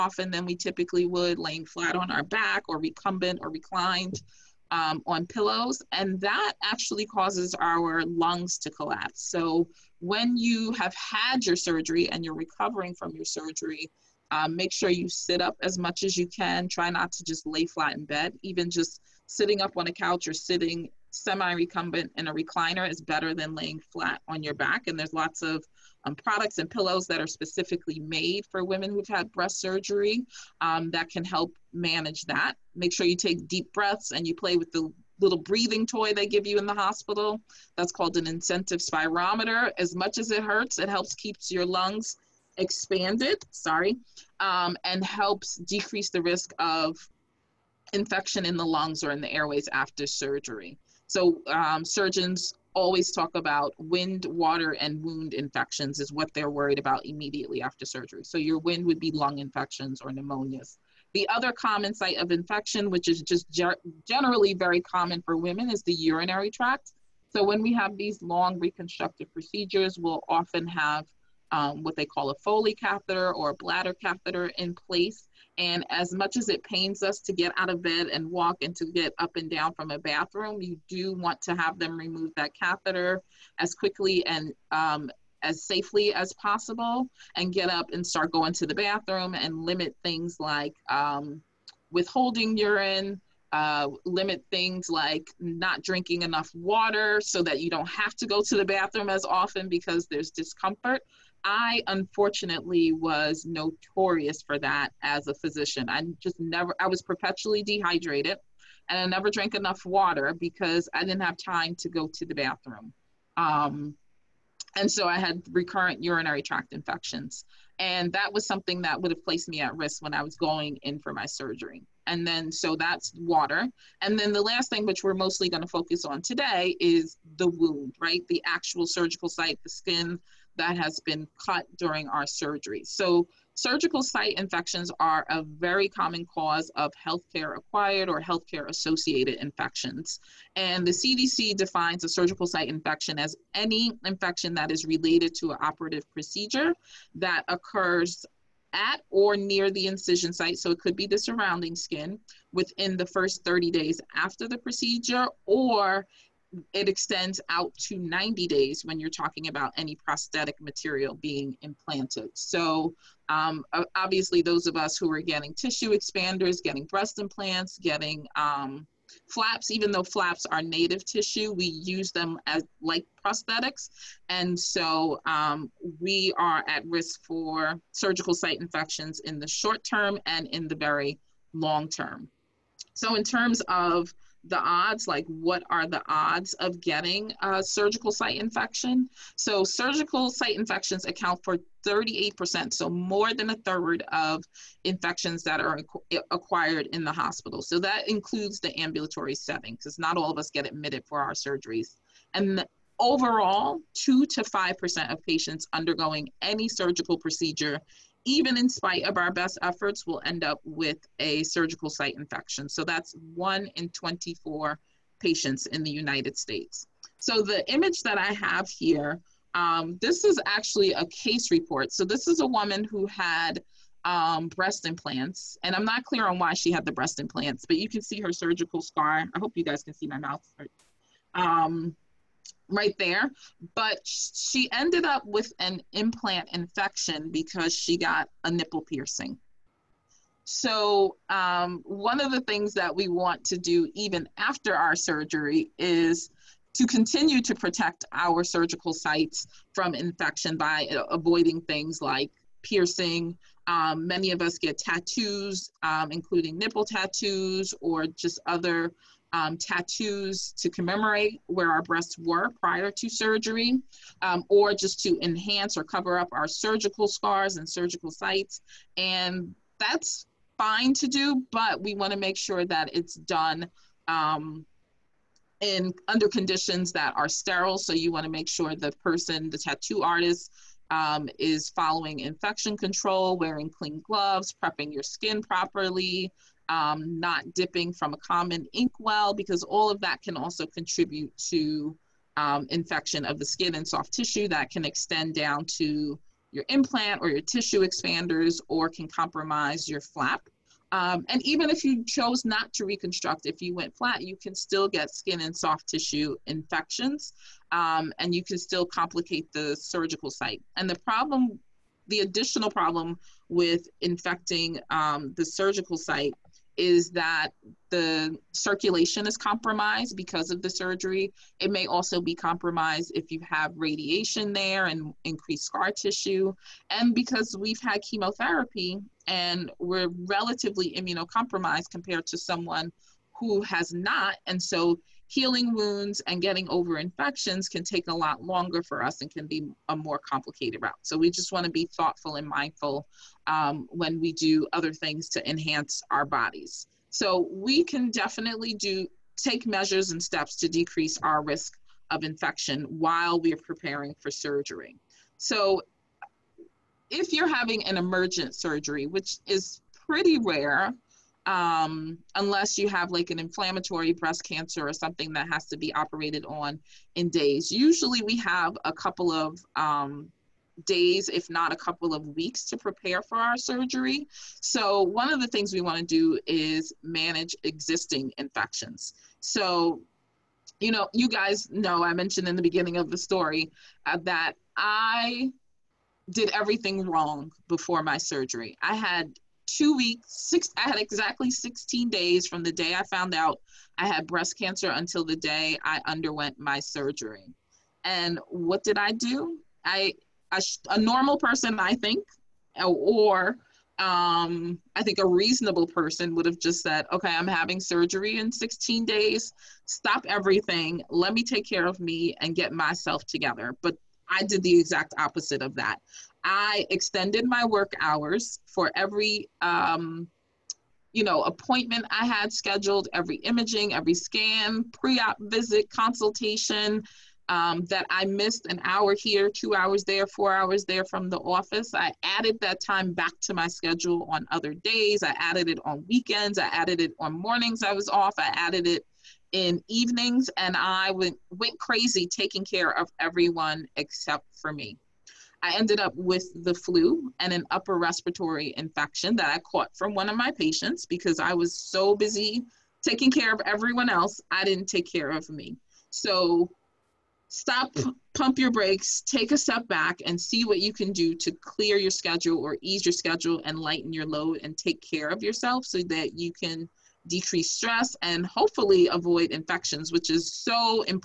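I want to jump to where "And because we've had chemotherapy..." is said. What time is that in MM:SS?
05:26.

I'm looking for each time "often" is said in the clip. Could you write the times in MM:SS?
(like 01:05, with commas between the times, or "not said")
01:10, 01:39.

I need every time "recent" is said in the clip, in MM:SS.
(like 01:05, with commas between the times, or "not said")
not said.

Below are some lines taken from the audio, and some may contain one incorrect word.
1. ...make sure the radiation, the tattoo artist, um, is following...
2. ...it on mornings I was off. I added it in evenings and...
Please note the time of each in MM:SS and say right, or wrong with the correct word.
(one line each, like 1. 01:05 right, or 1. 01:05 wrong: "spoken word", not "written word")
1. 04:38 wrong: "person", not "radiation"
2. 07:17 right.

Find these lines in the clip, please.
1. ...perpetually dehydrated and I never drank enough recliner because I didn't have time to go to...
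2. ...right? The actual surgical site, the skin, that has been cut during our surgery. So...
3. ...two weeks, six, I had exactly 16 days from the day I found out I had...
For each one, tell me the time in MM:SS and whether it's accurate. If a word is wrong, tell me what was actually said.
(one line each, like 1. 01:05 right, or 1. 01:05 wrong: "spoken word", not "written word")
1. 01:47 wrong: "water", not "recliner"
2. 02:08 right
3. 06:29 right.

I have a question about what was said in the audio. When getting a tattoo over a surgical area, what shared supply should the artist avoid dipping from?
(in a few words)
common inkwell.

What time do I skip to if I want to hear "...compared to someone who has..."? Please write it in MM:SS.
05:31.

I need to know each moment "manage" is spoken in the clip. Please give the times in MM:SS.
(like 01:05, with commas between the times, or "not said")
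00:31, 06:17.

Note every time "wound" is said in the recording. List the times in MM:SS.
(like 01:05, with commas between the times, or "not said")
00:55, 02:07, 05:35.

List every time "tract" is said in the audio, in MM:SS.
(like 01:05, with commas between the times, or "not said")
01:06, 01:56.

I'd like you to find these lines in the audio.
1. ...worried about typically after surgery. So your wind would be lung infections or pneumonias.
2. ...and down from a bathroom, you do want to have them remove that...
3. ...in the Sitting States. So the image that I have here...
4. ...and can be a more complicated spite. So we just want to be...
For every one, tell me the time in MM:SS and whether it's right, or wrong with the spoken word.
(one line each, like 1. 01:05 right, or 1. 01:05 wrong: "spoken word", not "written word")
1. 00:56 wrong: "immediately", not "typically"
2. 01:19 right
3. 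03:35 wrong: "United", not "Sitting"
4. 05:39 wrong: "route", not "spite".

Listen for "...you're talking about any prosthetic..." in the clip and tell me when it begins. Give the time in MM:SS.
02:38.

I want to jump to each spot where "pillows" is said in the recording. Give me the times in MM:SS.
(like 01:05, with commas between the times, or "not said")
00:05, 00:26.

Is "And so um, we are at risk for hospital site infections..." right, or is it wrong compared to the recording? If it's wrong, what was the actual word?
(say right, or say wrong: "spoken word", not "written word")
wrong: "surgical", not "hospital".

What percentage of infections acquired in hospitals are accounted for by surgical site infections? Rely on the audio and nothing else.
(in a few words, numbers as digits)
38%.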